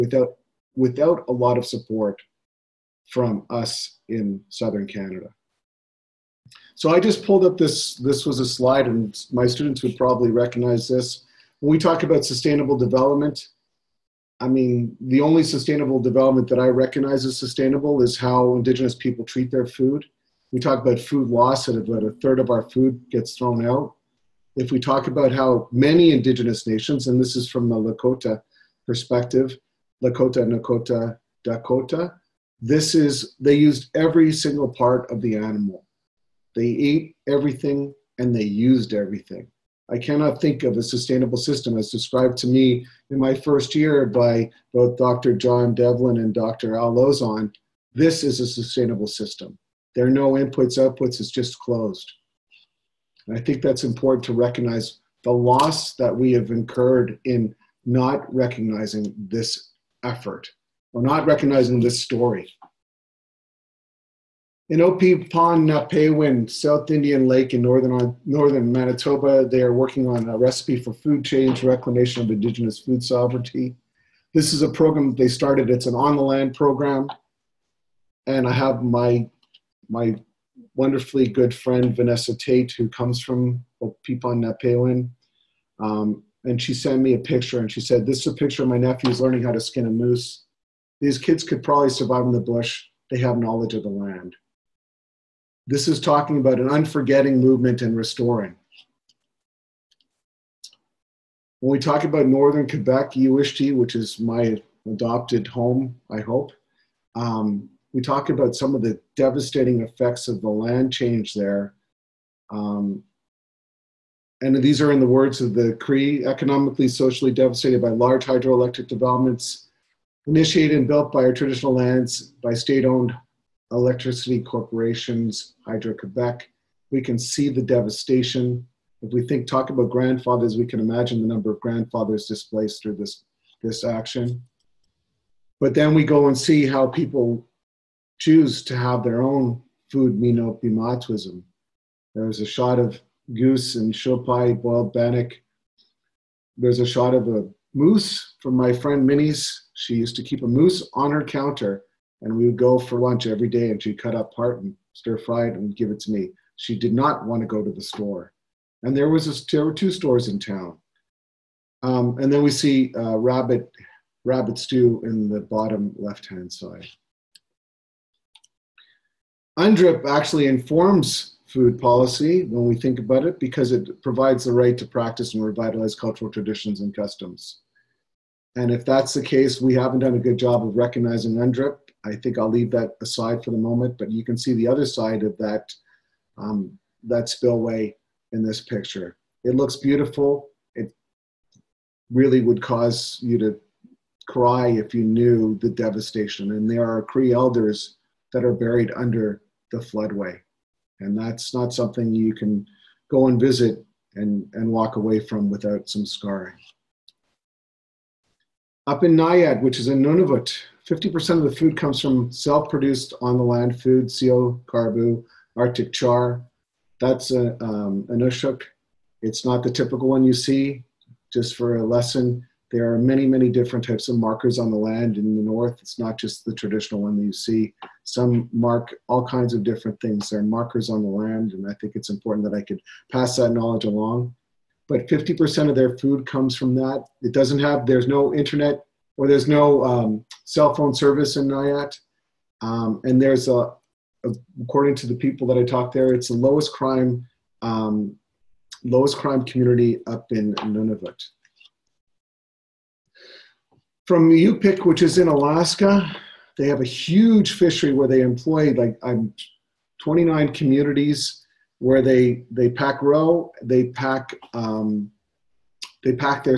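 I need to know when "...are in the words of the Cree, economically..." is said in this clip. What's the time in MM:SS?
01:54.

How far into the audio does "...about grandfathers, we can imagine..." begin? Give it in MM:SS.
02:09.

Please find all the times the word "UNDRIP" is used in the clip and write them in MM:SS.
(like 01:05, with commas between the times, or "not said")
02:49, 03:01.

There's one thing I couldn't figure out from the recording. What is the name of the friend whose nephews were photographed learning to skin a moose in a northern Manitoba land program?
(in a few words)
Vanessa Tate.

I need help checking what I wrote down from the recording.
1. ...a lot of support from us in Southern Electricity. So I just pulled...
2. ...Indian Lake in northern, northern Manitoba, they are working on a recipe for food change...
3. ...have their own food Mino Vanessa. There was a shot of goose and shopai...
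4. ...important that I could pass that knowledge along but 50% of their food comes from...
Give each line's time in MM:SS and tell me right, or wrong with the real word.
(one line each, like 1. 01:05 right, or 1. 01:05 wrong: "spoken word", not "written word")
1. 00:01 wrong: "Canada", not "Electricity"
2. 01:06 right
3. 02:18 wrong: "Bimaadiziwin", not "Vanessa"
4. 03:52 right.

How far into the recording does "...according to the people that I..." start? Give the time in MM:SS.
04:04.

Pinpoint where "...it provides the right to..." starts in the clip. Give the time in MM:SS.
02:53.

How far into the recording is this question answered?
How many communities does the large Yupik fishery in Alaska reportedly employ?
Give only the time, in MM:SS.
04:20.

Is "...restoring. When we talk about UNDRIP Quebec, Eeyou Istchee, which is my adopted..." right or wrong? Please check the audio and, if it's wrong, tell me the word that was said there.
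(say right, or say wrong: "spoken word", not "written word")
wrong: "Northern", not "UNDRIP".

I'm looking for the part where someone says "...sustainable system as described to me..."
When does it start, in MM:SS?
00:40.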